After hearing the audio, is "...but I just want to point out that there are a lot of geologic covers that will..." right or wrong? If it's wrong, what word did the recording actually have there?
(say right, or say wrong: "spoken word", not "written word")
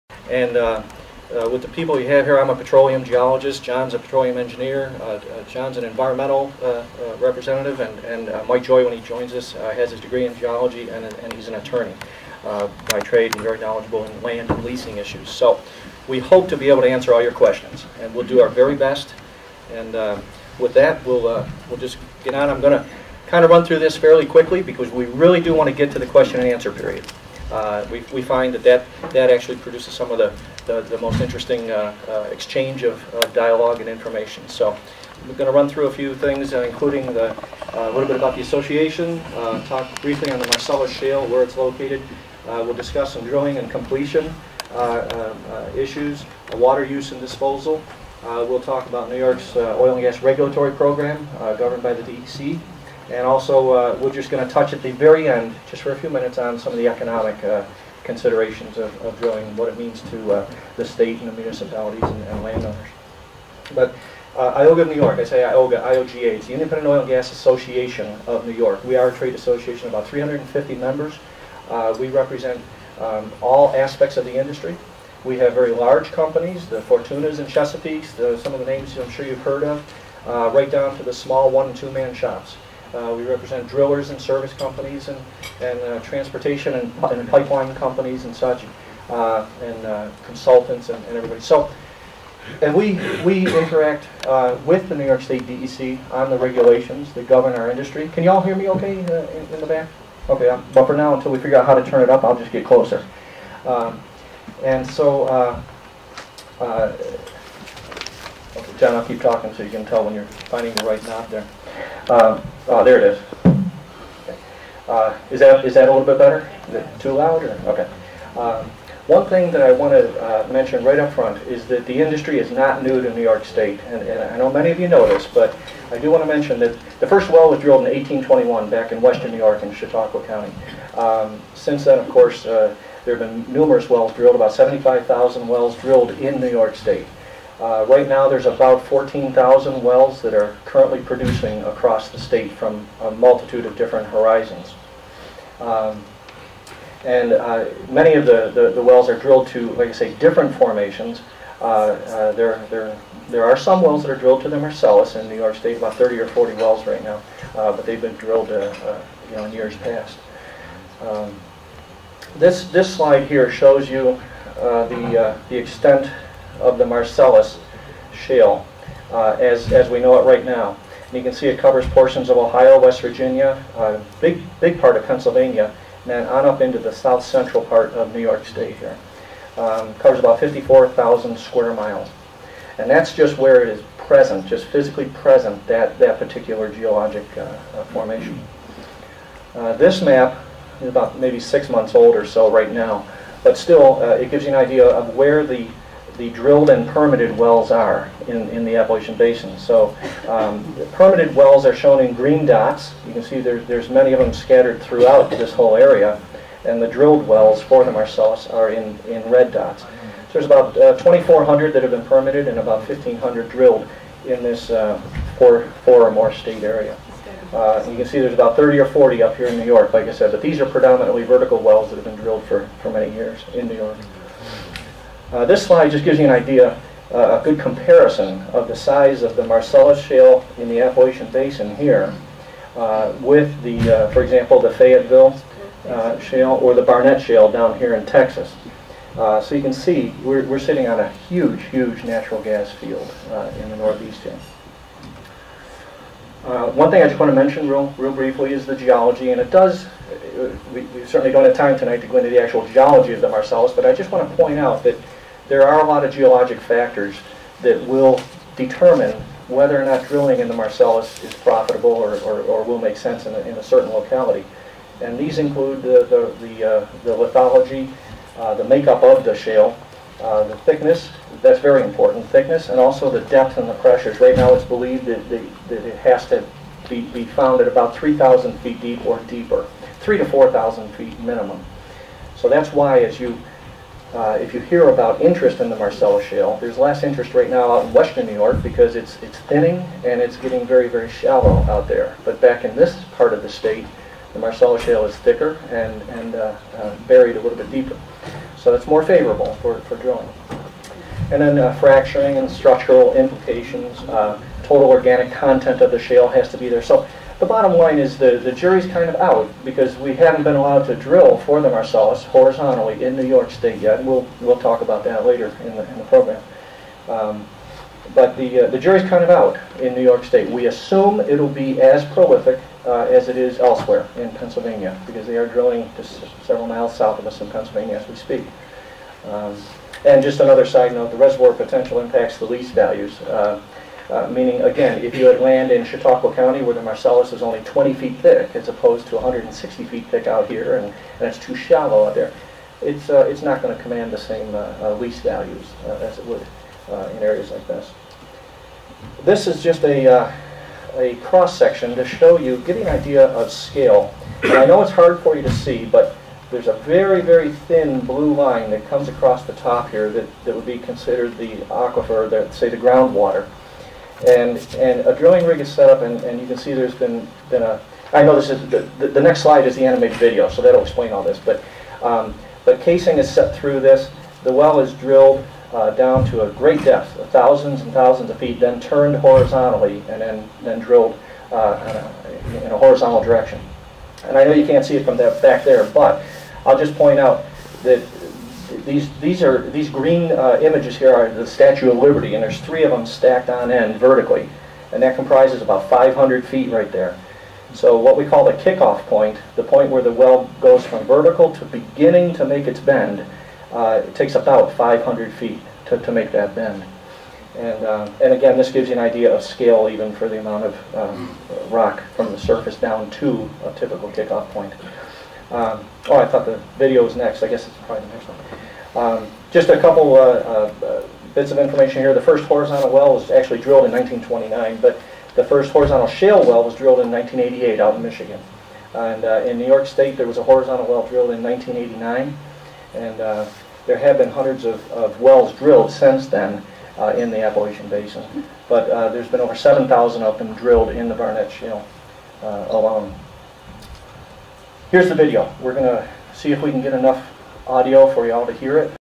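wrong: "factors", not "covers".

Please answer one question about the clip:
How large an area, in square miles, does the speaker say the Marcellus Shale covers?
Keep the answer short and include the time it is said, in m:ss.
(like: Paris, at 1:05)
54,000 square miles, at 3:00.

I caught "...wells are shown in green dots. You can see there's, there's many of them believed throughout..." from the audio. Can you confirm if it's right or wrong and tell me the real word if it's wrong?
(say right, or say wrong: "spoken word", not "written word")
wrong: "scattered", not "believed".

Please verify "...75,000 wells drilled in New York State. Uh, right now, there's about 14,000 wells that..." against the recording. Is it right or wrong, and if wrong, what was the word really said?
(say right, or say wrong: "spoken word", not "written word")
right.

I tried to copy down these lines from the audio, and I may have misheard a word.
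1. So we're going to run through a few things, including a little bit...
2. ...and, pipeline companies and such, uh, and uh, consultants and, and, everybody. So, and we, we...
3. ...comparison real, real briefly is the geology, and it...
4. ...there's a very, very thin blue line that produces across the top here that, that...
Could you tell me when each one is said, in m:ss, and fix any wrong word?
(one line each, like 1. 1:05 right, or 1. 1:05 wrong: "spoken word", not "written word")
1. 0:34 right
2. 1:27 right
3. 4:07 wrong: "mention", not "comparison"
4. 5:56 wrong: "comes", not "produces".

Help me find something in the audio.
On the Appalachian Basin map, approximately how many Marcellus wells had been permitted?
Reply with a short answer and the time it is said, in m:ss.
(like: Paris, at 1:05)
2,400, at 3:30.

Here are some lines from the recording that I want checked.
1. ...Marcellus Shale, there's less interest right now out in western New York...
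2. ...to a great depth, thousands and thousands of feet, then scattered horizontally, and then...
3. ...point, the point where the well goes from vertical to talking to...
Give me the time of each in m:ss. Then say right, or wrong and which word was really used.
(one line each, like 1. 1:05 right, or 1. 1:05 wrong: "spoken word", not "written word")
1. 4:45 right
2. 6:16 wrong: "turned", not "scattered"
3. 6:39 wrong: "beginning", not "talking".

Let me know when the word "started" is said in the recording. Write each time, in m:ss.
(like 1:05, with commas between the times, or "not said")
not said.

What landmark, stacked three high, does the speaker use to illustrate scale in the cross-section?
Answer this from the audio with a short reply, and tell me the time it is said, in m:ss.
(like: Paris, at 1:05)
Statue of Liberty, at 6:31.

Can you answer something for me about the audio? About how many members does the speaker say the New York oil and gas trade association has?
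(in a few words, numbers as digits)
350.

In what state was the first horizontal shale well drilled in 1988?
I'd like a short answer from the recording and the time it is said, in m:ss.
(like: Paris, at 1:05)
Michigan, at 7:07.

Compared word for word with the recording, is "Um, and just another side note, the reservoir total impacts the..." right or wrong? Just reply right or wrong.
wrong.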